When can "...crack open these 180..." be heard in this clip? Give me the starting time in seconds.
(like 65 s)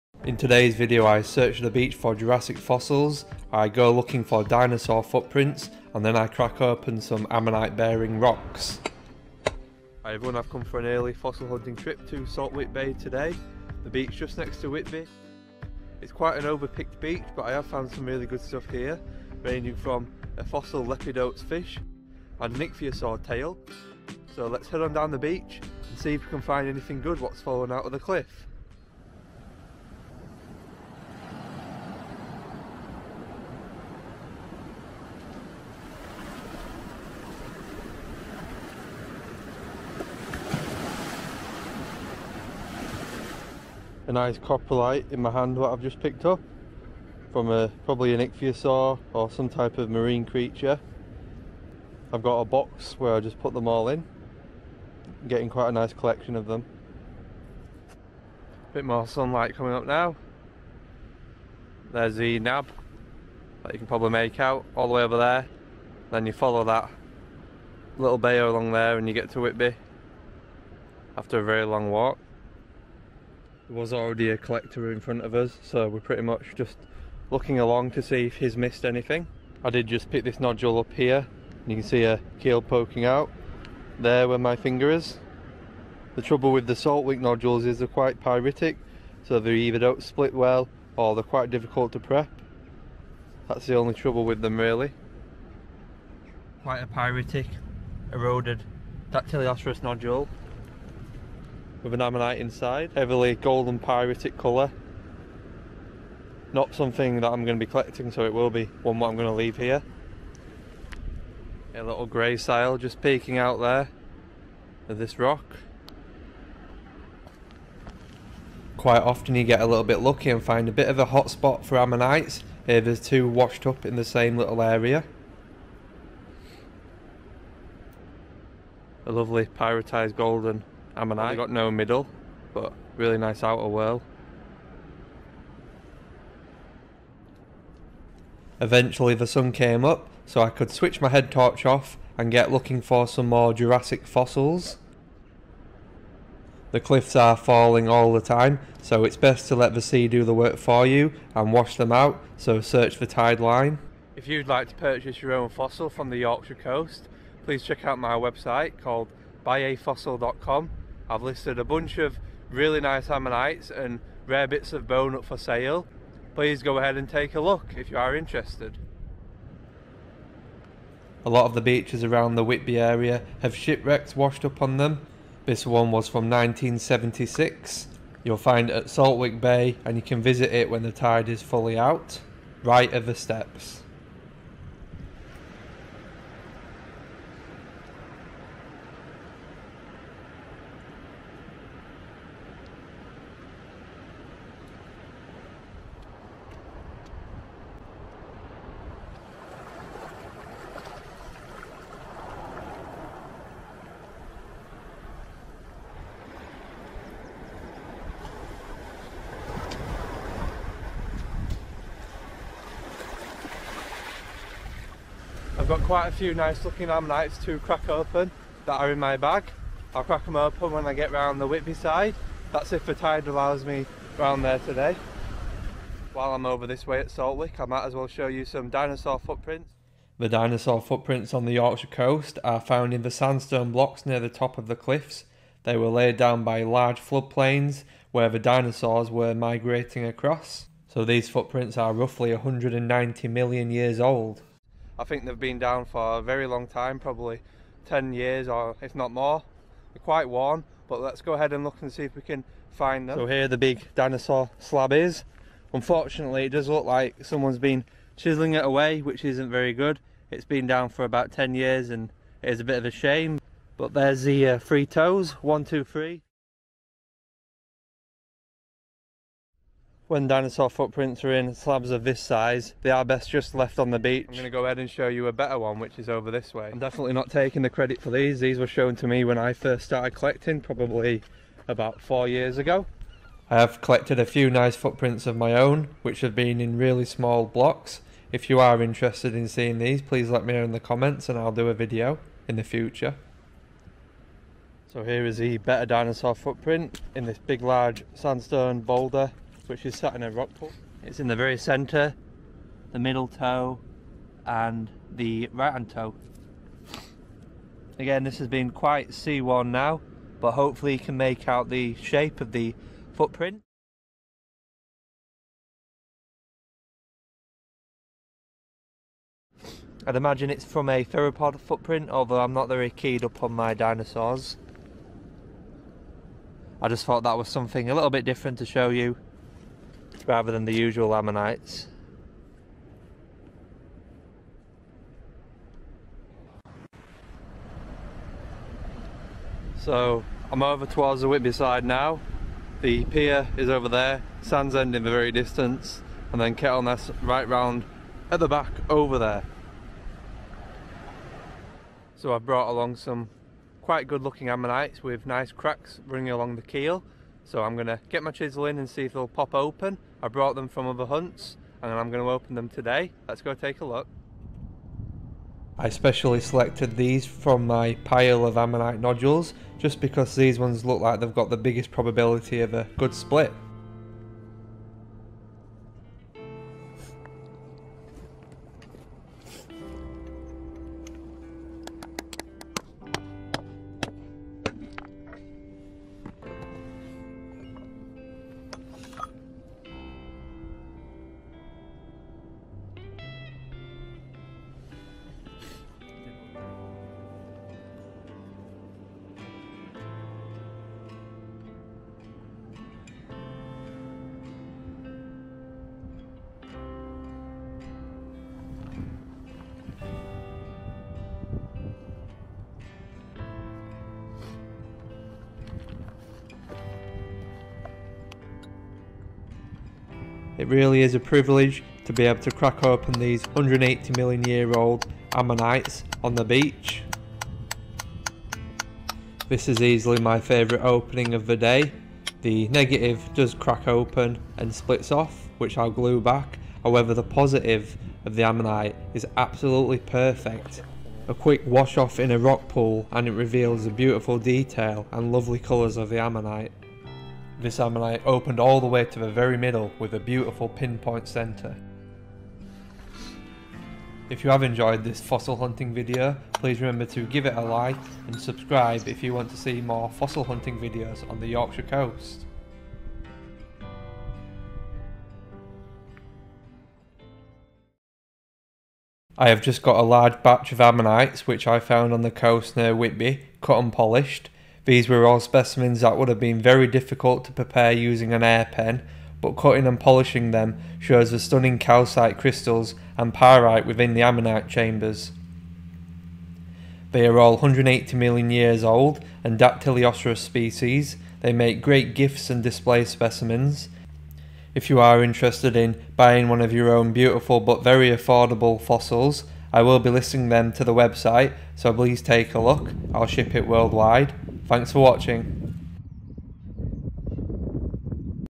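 422 s.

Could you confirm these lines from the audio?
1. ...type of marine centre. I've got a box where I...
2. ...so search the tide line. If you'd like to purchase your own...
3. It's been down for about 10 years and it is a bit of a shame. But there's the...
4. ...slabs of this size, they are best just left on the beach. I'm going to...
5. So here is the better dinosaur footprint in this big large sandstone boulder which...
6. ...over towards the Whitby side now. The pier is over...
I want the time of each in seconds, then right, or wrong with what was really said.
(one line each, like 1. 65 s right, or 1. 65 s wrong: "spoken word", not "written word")
1. 49 s wrong: "creature", not "centre"
2. 152 s right
3. 260 s right
4. 271 s right
5. 294 s right
6. 340 s right.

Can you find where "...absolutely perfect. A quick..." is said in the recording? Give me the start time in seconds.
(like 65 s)
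439 s.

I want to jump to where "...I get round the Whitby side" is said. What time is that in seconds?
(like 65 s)
220 s.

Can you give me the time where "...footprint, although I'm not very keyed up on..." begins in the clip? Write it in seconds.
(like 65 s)
321 s.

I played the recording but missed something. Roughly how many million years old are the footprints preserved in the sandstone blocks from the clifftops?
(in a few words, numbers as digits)
190 million.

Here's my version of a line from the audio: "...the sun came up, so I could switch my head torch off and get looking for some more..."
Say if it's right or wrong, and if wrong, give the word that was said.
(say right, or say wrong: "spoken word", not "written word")
right.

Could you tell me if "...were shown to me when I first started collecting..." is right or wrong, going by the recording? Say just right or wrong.
right.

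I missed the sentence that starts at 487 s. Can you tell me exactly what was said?
They are all 180 million years old and dactylioceras species.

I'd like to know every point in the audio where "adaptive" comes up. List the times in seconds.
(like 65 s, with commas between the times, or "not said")
not said.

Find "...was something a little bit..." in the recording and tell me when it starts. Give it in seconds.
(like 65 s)
327 s.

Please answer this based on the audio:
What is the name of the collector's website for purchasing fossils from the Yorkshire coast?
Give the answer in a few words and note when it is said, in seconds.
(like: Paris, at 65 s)
buyafossil.com, at 159 s.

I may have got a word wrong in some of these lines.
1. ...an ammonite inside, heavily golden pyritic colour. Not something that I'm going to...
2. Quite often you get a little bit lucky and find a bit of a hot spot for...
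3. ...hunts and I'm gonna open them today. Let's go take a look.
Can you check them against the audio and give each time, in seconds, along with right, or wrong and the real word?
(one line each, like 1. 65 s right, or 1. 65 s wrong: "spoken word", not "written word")
1. 101 s right
2. 118 s right
3. 361 s right.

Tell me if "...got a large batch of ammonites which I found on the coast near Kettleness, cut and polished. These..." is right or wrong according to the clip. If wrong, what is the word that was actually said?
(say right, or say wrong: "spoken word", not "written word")
wrong: "Whitby", not "Kettleness".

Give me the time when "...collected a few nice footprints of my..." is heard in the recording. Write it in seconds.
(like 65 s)
283 s.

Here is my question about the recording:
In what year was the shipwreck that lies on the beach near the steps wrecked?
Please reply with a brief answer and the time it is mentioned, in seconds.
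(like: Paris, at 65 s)
1976, at 176 s.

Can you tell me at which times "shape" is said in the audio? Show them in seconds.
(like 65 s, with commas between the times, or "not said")
311 s.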